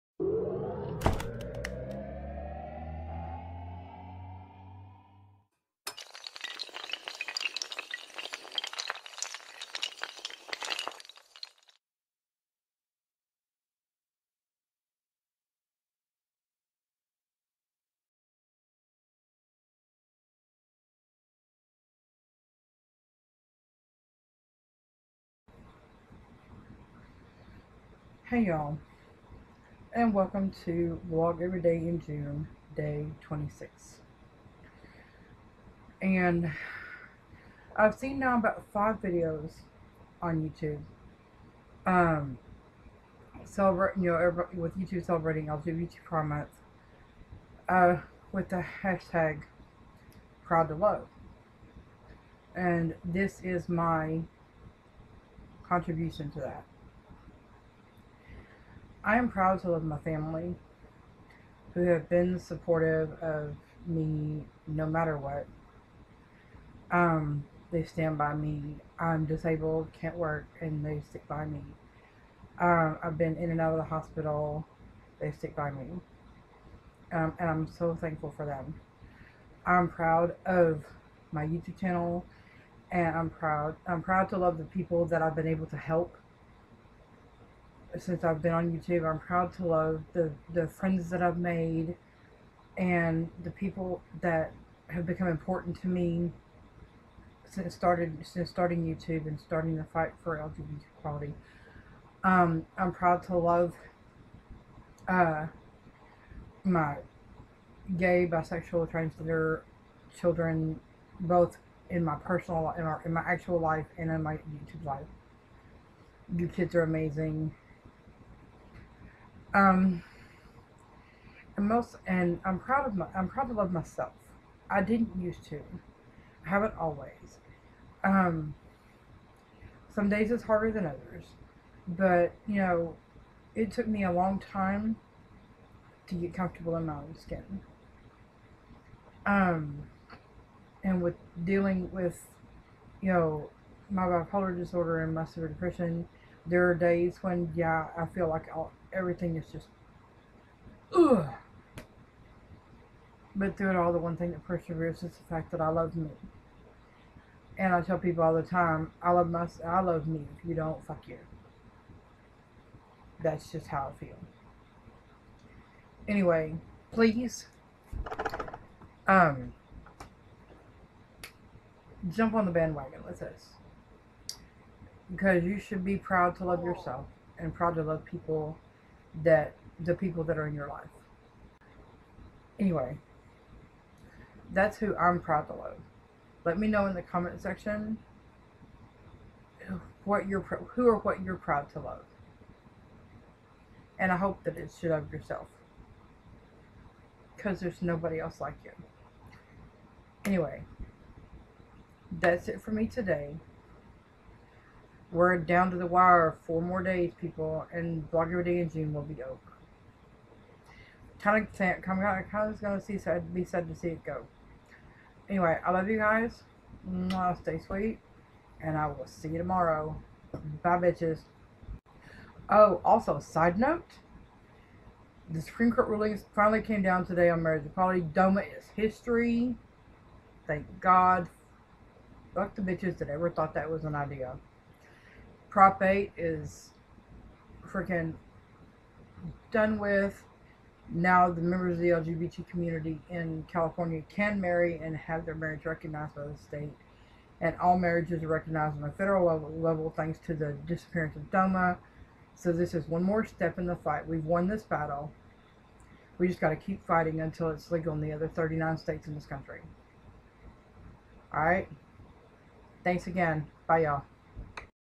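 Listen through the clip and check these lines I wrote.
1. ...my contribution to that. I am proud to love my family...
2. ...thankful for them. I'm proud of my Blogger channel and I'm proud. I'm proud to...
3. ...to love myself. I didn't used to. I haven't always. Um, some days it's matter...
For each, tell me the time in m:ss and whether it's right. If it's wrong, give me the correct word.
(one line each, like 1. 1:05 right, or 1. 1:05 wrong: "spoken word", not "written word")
1. 0:53 right
2. 1:17 wrong: "YouTube", not "Blogger"
3. 2:03 wrong: "harder", not "matter".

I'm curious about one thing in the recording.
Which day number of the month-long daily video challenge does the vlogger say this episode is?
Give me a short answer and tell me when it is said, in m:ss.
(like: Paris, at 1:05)
26, at 0:32.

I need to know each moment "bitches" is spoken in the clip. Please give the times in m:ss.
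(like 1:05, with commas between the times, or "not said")
3:40, 3:52.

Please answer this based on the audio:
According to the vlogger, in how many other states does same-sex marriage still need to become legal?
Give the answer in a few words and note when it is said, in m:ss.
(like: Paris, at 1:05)
39, at 4:18.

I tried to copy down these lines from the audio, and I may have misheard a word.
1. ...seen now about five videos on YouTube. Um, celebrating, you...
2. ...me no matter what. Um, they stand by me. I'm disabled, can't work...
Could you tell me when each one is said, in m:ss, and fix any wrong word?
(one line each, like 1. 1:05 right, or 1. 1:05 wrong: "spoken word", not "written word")
1. 0:37 right
2. 1:03 right.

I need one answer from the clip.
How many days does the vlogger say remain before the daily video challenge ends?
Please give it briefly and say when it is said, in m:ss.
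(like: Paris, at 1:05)
4, at 3:26.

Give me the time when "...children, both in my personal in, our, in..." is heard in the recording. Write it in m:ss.
1:50.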